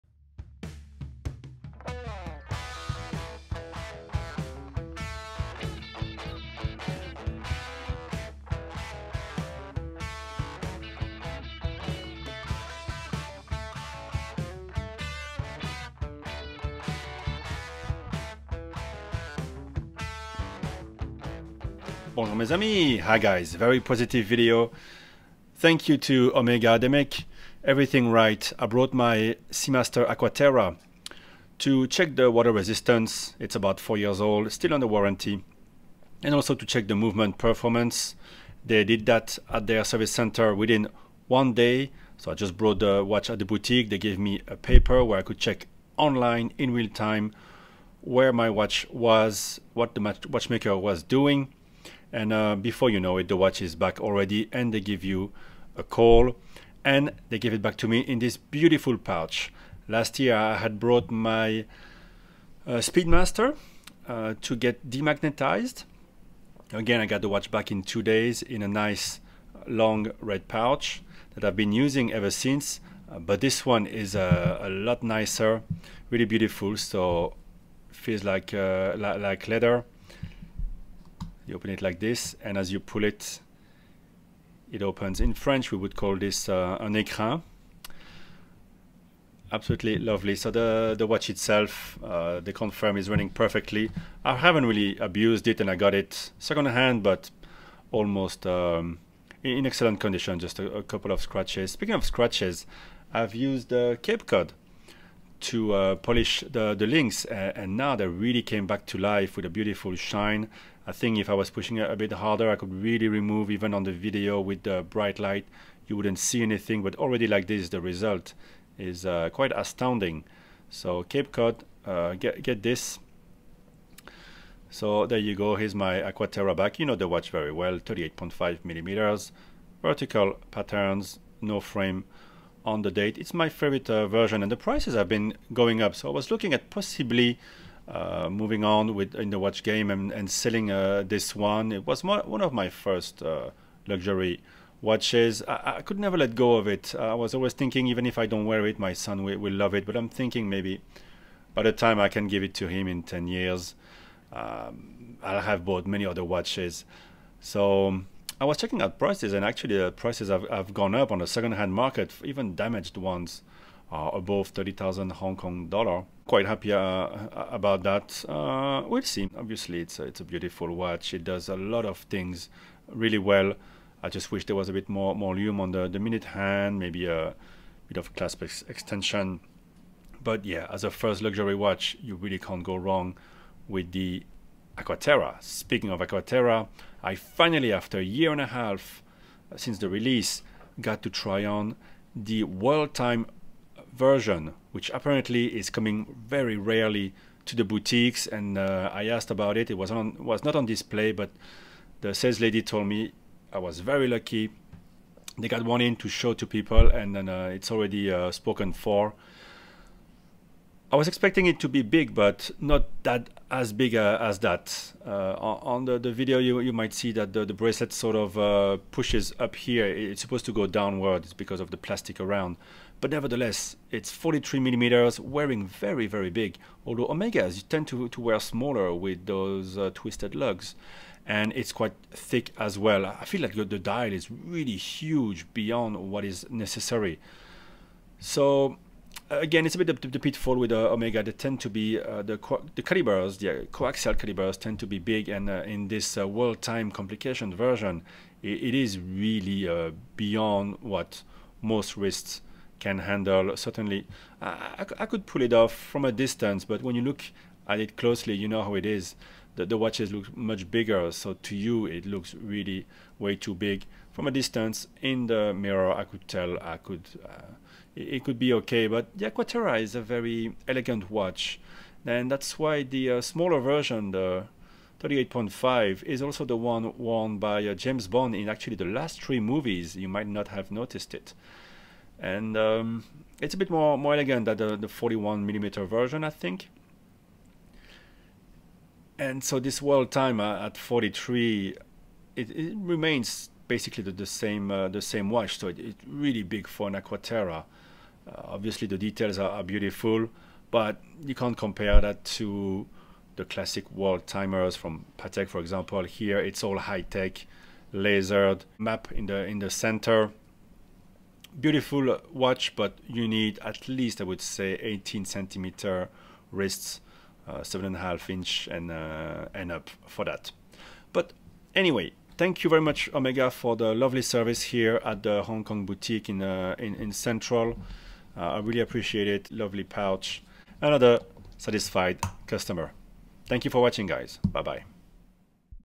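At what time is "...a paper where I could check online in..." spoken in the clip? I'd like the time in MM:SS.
00:44.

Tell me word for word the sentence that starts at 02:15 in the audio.
So I was looking at possibly uh, moving on with in the watch game and, and selling uh, this one.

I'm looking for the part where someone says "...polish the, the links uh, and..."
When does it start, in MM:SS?
01:45.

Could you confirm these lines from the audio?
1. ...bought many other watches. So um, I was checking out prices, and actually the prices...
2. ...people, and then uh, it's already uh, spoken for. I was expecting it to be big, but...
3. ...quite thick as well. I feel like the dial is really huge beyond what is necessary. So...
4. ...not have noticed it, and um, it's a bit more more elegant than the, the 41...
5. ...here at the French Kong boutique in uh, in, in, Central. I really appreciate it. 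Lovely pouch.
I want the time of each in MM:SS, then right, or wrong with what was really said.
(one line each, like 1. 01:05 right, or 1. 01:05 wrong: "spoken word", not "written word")
1. 02:35 right
2. 03:26 right
3. 03:51 right
4. 04:40 right
5. 05:24 wrong: "Hong", not "French".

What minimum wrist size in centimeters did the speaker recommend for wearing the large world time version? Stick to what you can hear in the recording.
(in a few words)
18 centimeters.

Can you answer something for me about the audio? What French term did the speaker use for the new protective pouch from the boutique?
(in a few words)
un écran.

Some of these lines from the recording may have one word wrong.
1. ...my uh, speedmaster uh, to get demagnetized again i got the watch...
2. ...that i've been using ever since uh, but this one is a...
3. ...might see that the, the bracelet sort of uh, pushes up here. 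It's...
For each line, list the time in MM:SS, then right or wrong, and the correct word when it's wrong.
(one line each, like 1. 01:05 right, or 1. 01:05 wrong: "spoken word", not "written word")
1. 01:01 right
2. 01:11 right
3. 03:36 right.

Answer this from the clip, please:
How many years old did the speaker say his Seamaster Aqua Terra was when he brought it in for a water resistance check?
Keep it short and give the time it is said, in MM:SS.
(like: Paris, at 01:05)
4, at 00:33.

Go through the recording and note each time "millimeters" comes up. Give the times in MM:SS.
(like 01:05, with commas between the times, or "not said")
02:08, 03:44, 04:45.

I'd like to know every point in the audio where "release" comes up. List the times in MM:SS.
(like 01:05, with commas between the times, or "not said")
03:09.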